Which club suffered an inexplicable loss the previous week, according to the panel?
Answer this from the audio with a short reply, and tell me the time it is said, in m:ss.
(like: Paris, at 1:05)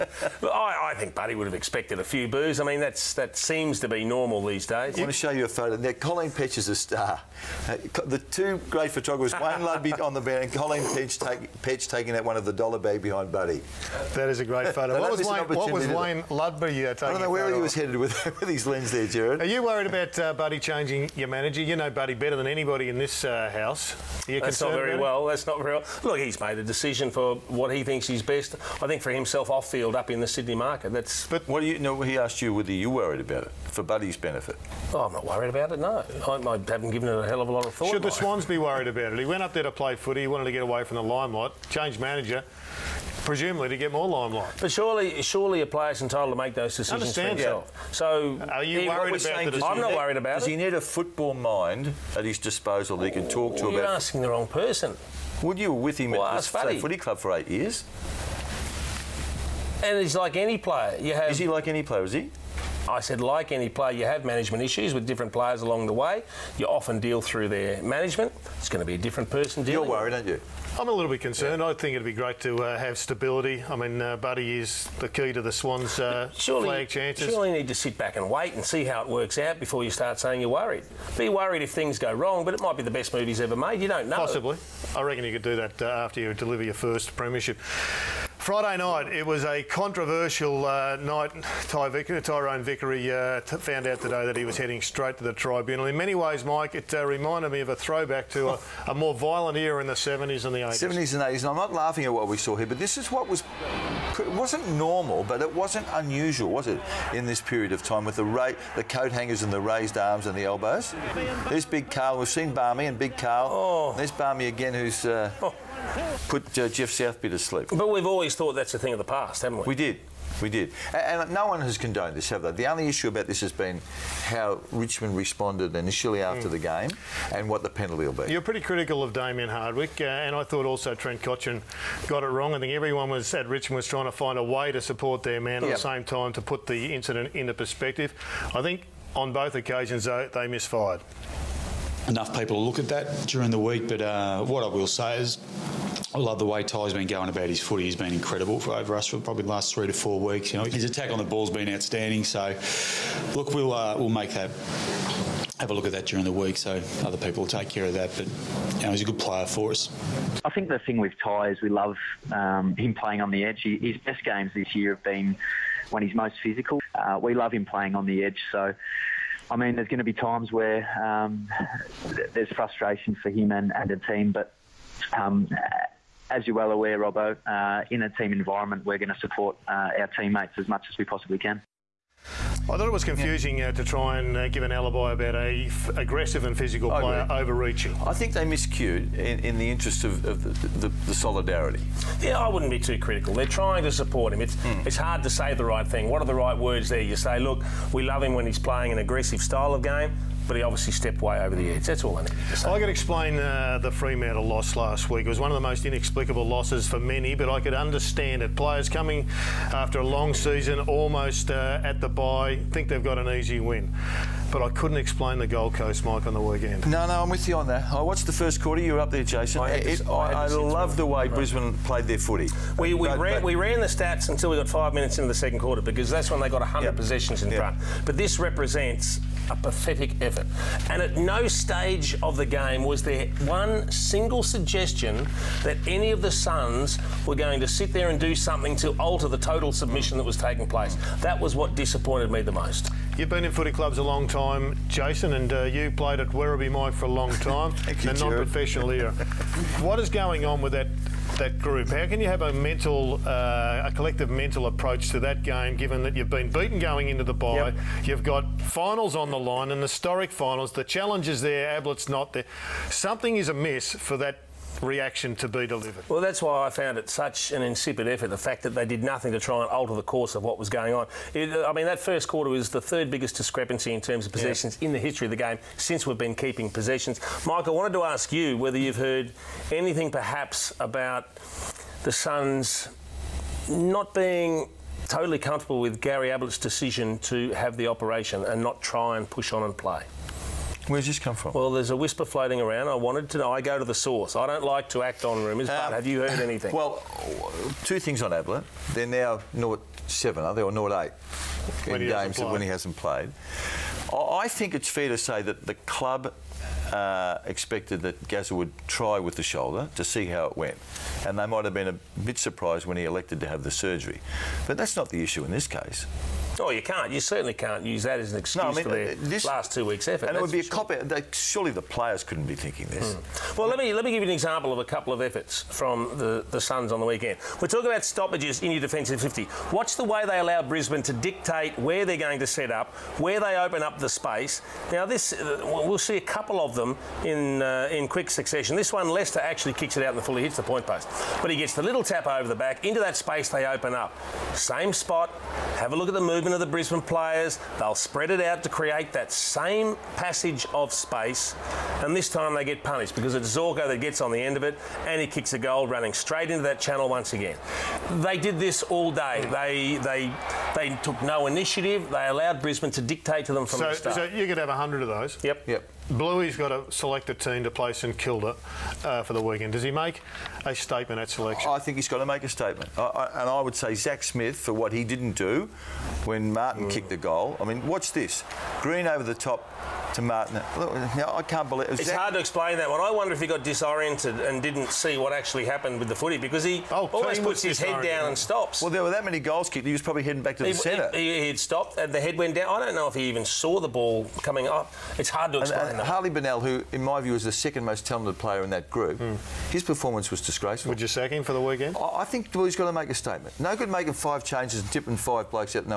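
Fremantle, at 3:23.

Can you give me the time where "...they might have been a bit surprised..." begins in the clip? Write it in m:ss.
5:11.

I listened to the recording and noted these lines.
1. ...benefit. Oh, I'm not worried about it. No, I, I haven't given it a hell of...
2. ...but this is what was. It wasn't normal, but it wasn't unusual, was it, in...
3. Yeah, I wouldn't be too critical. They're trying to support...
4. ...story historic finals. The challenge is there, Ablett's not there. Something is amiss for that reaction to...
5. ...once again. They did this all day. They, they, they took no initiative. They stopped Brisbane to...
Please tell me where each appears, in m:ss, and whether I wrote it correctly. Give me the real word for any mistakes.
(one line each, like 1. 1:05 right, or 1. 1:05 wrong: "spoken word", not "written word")
1. 0:34 right
2. 1:42 right
3. 3:12 right
4. 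4:19 right
5. 5:57 wrong: "allowed", not "stopped".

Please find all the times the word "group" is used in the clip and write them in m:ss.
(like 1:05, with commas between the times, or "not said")
4:11, 6:38.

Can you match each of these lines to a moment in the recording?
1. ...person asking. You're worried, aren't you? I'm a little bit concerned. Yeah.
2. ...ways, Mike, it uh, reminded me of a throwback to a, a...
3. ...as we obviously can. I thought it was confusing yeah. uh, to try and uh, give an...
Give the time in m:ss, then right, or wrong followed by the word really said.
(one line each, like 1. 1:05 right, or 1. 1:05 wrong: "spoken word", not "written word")
1. 1:09 wrong: "dealing", not "asking"
2. 1:36 right
3. 3:00 wrong: "possibly", not "obviously".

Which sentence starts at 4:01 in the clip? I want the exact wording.
That was what disappointed me the most.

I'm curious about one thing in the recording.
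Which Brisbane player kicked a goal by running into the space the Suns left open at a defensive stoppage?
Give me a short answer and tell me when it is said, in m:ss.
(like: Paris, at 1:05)
Zorko, at 5:53.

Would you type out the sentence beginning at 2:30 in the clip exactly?
You know, his attack on the ball's been outstanding.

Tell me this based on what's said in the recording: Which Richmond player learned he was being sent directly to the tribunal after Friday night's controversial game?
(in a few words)
Tyrone Vickery.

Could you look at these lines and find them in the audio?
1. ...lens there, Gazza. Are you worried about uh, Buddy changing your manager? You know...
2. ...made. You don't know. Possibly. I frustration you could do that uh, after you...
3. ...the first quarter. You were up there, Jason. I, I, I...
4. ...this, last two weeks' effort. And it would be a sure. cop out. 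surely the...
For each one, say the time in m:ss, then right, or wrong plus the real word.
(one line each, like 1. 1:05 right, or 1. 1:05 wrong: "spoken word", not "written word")
1. 0:18 wrong: "Gerard", not "Gazza"
2. 1:23 wrong: "reckon", not "frustration"
3. 3:38 right
4. 5:19 right.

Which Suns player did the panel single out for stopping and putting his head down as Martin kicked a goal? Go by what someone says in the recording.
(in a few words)
Zach Smith.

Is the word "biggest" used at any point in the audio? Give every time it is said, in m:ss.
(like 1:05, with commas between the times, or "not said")
4:33.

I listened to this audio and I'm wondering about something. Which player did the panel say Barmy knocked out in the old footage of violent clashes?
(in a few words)
Geoff Southby.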